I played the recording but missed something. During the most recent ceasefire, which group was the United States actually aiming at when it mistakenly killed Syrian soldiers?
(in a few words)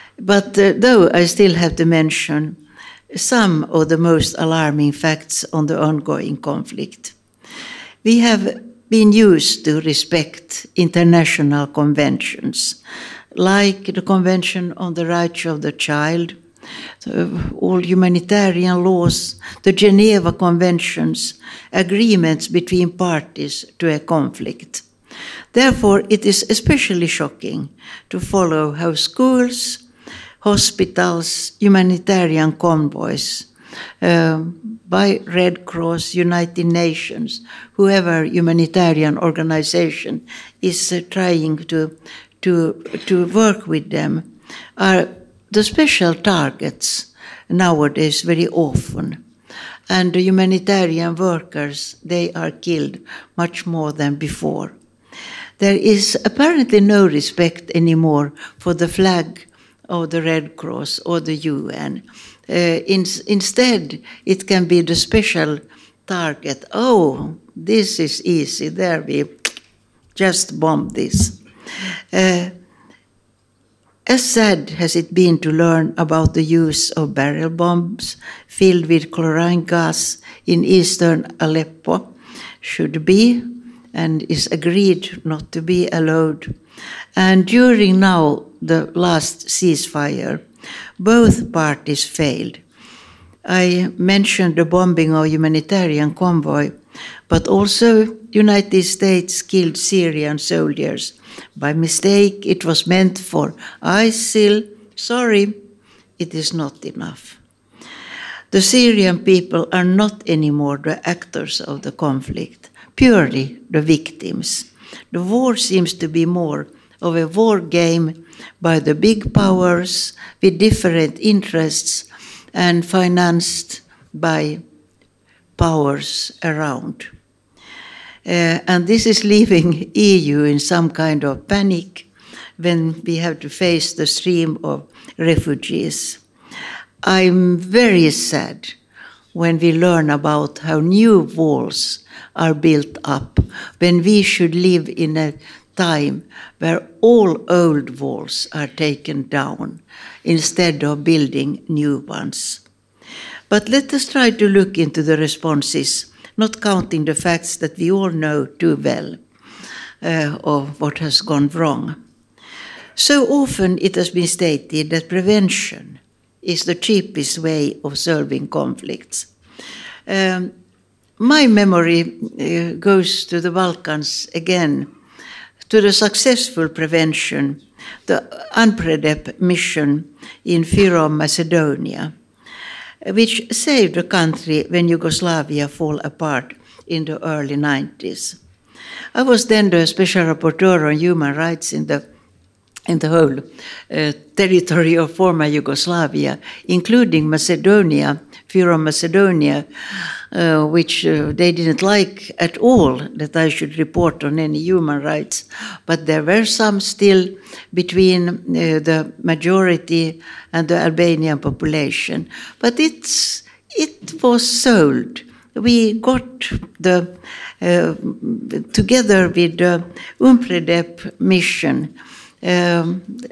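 ISIL.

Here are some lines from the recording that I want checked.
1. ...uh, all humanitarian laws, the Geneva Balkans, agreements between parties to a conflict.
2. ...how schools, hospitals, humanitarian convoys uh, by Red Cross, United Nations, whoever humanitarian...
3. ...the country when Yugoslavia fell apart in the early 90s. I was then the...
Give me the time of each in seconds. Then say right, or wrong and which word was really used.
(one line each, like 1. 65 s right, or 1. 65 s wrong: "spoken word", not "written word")
1. 17 s wrong: "Conventions", not "Balkans"
2. 28 s right
3. 183 s right.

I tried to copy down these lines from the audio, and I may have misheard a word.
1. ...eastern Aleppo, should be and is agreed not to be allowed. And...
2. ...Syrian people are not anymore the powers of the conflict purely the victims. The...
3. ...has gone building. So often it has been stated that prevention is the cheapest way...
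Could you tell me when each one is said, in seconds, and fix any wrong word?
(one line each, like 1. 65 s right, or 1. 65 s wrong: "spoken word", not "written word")
1. 80 s right
2. 108 s wrong: "actors", not "powers"
3. 160 s wrong: "wrong", not "building".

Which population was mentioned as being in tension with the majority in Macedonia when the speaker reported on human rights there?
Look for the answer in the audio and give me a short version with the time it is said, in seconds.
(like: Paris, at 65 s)
Albanian population, at 210 s.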